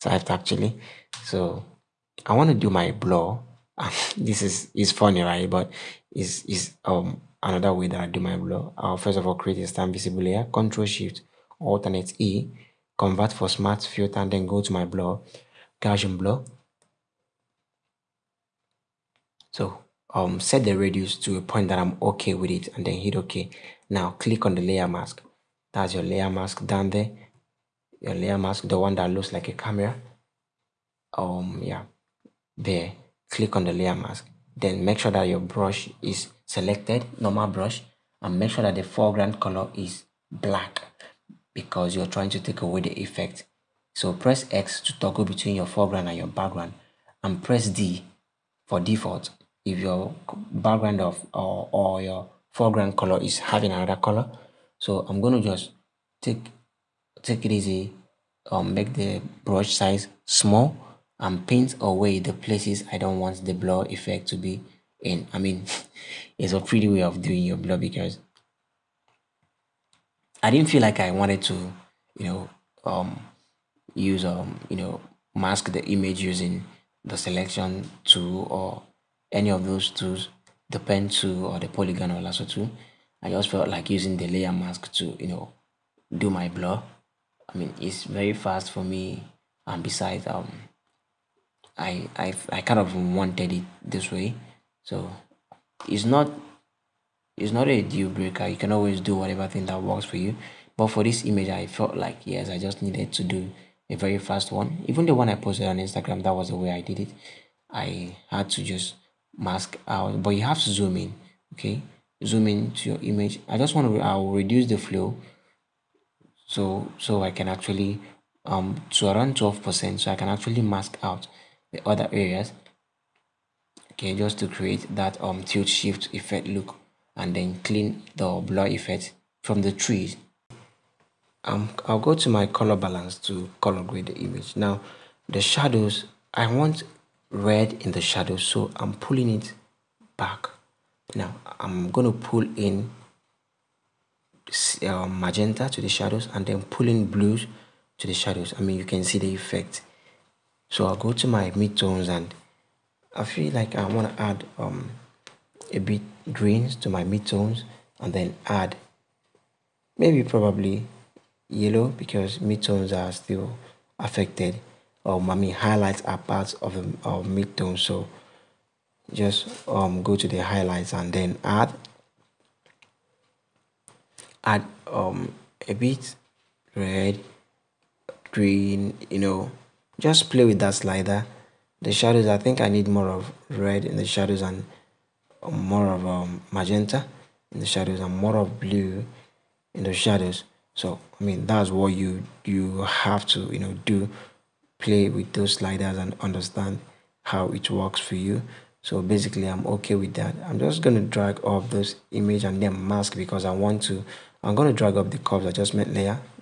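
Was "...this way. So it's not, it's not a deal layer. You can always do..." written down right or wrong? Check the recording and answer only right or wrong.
wrong.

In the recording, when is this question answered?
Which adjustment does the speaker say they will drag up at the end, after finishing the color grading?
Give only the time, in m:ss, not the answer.
3:25.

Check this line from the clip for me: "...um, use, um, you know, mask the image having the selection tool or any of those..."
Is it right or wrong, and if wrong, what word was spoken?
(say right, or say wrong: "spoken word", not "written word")
wrong: "using", not "having".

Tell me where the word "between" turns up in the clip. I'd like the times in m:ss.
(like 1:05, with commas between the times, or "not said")
0:45.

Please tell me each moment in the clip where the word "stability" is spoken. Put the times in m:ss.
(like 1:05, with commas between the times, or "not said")
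not said.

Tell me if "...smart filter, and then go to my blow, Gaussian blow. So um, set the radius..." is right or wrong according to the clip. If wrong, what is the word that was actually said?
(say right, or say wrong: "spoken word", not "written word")
right.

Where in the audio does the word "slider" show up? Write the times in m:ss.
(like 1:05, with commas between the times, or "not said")
3:00, 3:15.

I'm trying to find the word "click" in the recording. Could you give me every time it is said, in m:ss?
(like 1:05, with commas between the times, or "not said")
0:24, 0:33.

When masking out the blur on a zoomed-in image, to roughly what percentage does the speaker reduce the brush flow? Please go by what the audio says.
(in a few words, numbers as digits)
12%.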